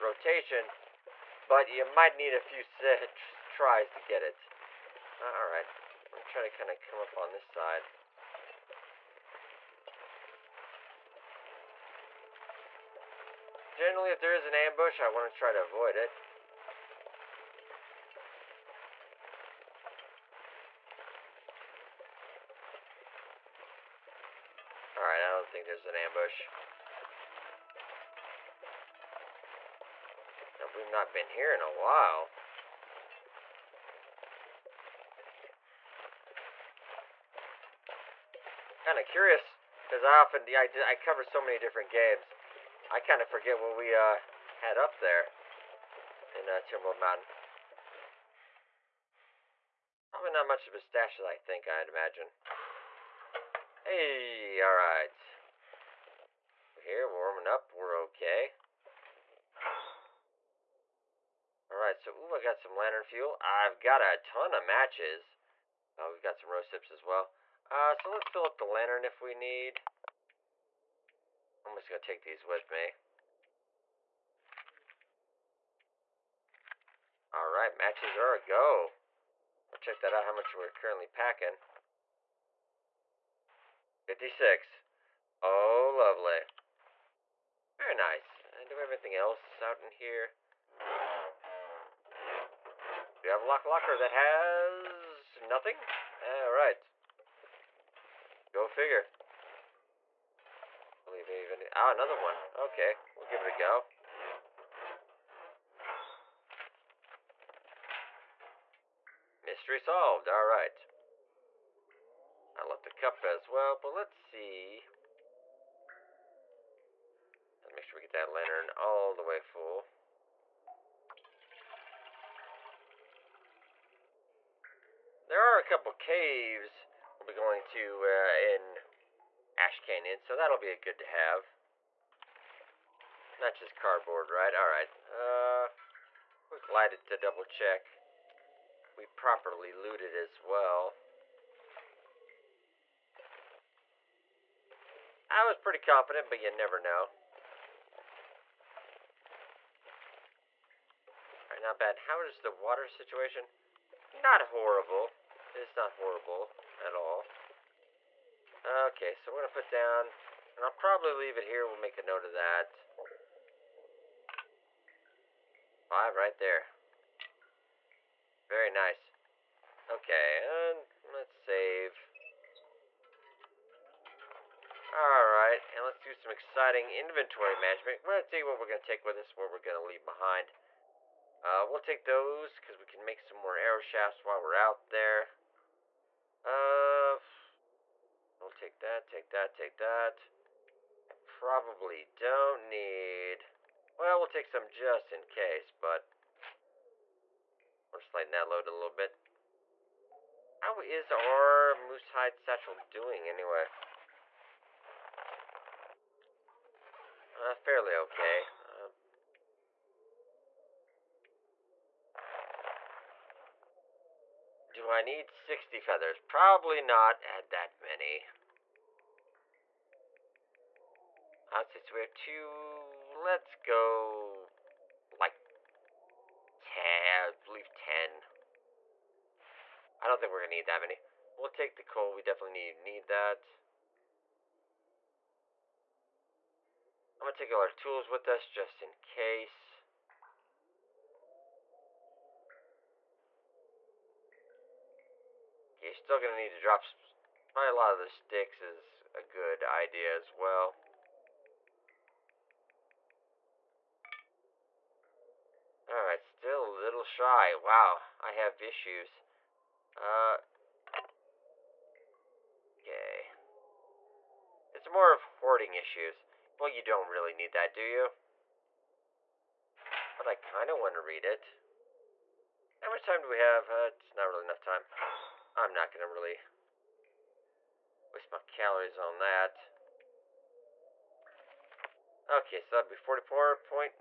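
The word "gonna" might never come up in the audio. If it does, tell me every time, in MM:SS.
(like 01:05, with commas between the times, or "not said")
03:50, 03:57, 04:06.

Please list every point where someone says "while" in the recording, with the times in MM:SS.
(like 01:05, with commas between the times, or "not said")
00:31, 03:04.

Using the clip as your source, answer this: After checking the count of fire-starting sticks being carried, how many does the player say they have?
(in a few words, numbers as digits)
56.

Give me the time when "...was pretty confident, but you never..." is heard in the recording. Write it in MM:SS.
02:25.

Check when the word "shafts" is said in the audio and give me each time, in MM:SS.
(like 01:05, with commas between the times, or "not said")
03:03.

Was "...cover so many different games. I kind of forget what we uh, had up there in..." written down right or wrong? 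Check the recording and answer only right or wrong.
right.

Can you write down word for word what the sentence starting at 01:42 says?
Okay, we'll give it a go.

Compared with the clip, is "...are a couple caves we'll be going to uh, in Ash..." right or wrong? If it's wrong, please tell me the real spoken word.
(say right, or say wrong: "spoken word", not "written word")
right.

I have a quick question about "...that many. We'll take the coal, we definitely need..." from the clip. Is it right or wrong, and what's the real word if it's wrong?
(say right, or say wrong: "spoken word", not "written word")
right.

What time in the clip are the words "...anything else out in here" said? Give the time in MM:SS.
01:28.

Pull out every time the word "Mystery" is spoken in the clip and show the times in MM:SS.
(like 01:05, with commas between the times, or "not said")
01:49.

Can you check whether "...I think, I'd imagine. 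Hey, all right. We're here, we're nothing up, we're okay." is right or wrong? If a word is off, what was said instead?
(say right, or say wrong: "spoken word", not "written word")
wrong: "warming", not "nothing".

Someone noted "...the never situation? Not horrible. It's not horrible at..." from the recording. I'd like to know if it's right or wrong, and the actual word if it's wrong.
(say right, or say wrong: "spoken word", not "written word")
wrong: "water", not "never".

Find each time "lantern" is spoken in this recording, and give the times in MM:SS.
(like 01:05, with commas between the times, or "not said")
01:02, 01:08, 01:58.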